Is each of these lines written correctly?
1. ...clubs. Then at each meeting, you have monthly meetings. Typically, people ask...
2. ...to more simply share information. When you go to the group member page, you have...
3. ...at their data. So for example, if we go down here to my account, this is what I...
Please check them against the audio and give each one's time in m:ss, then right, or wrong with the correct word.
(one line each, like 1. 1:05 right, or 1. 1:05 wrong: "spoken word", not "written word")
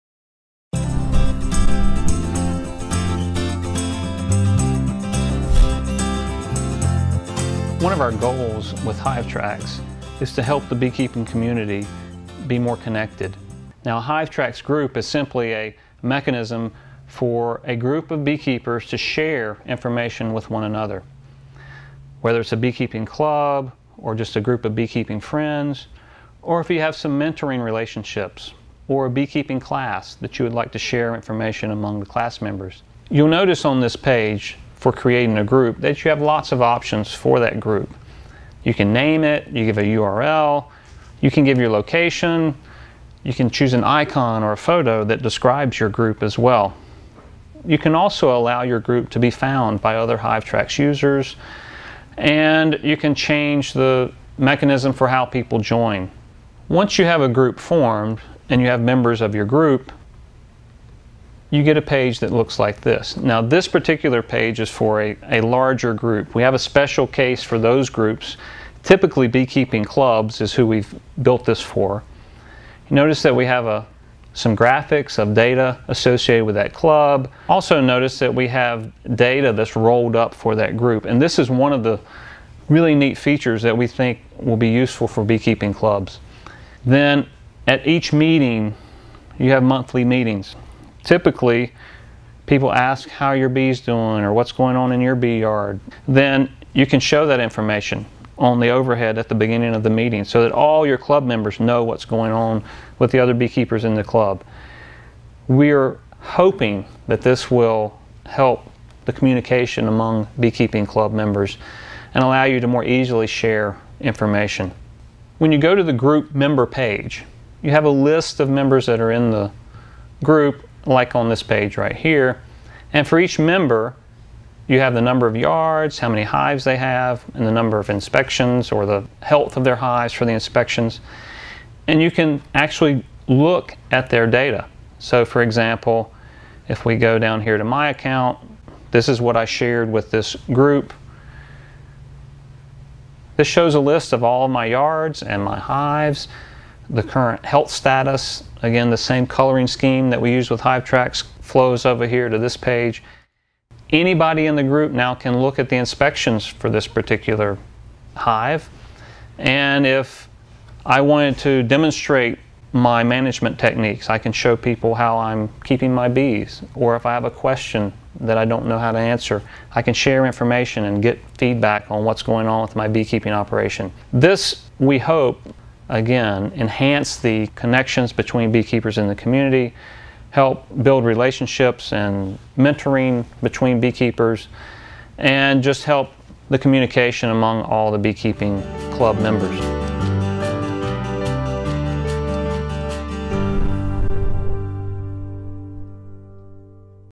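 1. 1:25 right
2. 1:52 wrong: "easily", not "simply"
3. 2:13 right.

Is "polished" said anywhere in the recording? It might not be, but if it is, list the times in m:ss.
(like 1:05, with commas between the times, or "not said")
not said.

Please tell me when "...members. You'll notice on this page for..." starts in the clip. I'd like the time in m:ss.
0:32.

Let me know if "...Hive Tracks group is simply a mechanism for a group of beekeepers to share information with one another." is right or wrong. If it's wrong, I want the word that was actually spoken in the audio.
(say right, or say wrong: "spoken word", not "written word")
right.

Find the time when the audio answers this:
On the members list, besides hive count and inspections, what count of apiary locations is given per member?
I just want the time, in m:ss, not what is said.
2:05.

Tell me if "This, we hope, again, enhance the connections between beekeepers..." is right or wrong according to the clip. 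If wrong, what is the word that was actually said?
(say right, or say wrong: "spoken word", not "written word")
right.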